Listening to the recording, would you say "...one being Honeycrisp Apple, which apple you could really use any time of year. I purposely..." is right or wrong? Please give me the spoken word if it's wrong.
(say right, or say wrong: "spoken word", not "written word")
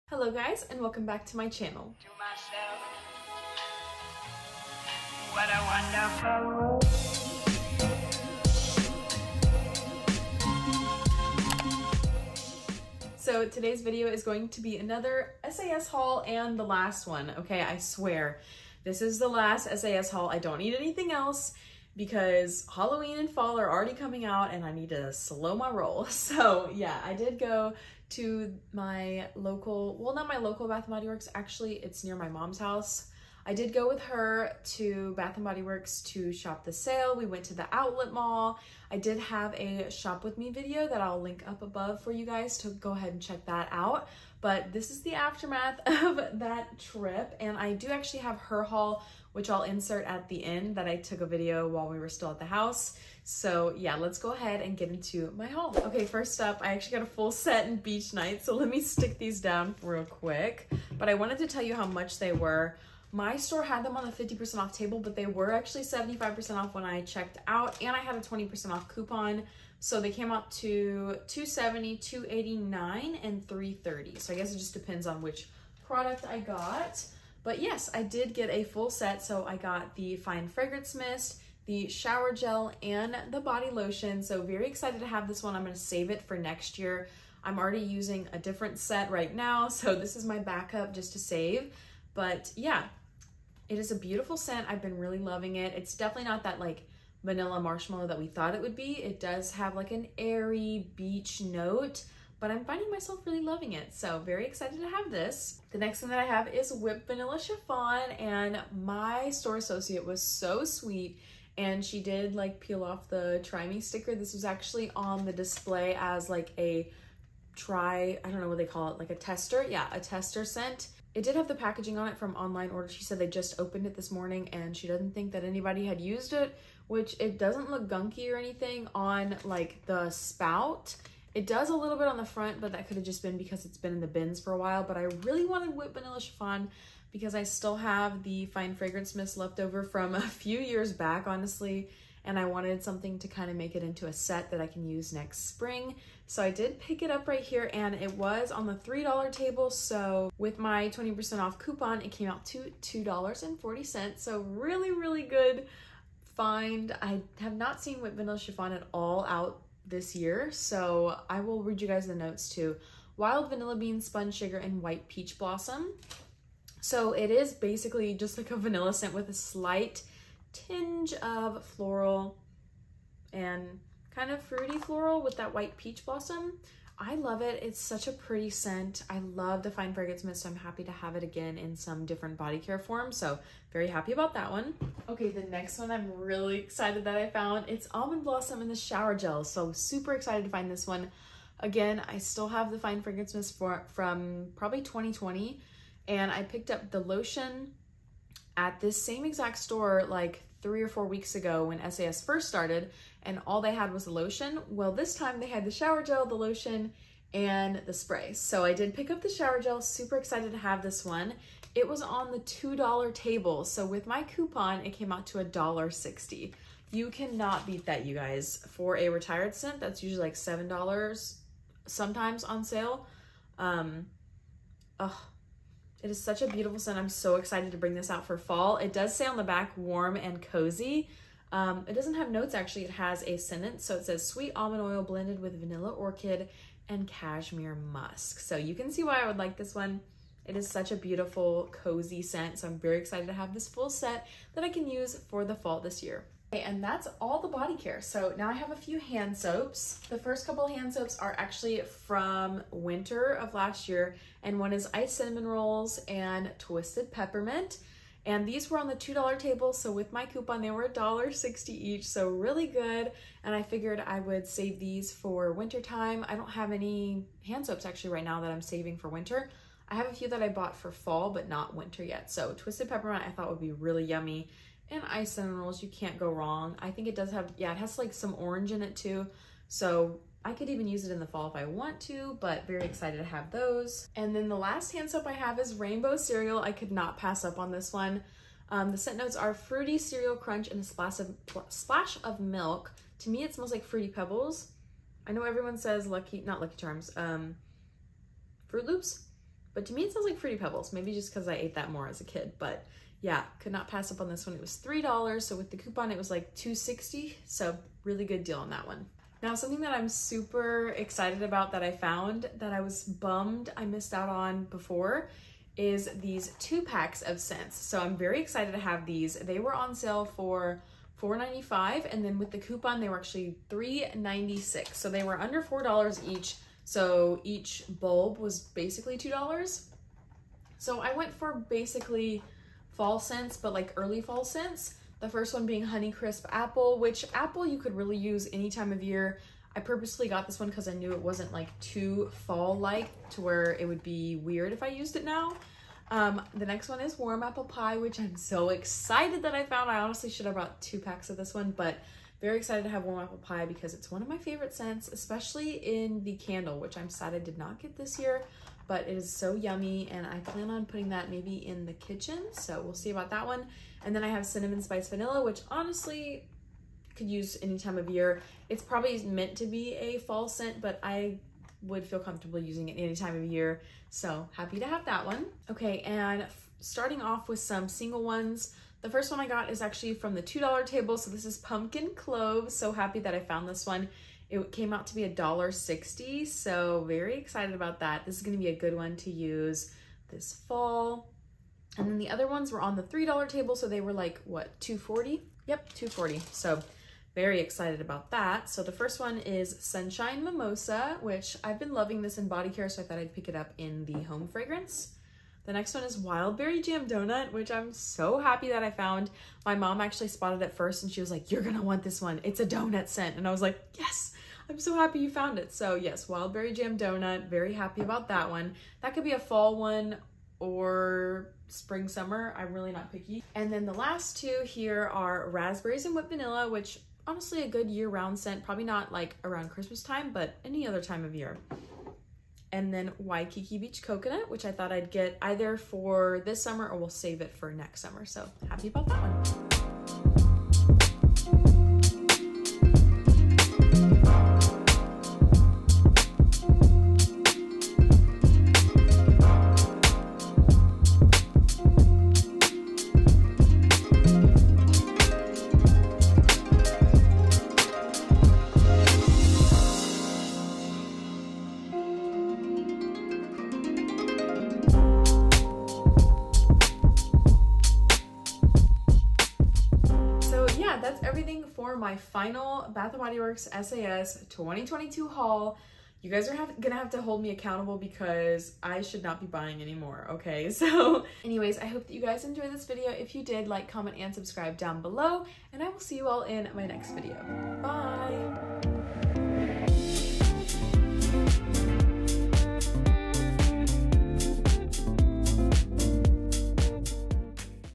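right.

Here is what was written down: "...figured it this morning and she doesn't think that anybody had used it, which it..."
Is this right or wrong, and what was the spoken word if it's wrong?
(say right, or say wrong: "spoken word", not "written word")
wrong: "opened", not "figured".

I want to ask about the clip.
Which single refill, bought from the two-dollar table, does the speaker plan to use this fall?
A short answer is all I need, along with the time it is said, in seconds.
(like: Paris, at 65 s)
Pumpkin Cloves, at 381 s.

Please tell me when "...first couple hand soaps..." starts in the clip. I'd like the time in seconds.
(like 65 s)
250 s.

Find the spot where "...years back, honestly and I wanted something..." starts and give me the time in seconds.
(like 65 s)
140 s.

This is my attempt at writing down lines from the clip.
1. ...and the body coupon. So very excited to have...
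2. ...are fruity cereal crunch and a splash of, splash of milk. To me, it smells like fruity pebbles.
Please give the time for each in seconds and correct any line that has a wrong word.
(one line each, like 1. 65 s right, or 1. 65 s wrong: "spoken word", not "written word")
1. 82 s wrong: "lotion", not "coupon"
2. 289 s right.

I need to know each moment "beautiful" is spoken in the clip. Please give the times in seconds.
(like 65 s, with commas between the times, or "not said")
93 s, 226 s, 240 s.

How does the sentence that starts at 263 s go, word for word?
And I figured I would save these for winter time.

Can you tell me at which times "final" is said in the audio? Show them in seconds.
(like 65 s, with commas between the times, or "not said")
472 s.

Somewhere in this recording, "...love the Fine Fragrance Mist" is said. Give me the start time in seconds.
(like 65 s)
179 s.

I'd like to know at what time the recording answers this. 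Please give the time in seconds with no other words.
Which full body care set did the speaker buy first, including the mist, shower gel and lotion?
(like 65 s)
57 s.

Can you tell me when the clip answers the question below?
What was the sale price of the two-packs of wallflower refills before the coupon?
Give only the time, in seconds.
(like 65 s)
321 s.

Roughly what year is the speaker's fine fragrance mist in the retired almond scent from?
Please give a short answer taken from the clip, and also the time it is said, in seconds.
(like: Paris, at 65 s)
2020, at 194 s.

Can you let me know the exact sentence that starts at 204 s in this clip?
Well, this time they had the shower gel, the lotion, and the spray.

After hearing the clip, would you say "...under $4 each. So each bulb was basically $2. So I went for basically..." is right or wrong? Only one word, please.
right.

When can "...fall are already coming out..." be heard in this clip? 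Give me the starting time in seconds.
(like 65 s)
23 s.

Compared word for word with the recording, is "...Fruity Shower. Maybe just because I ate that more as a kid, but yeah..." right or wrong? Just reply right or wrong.
wrong.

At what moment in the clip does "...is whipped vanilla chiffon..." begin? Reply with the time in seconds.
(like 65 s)
106 s.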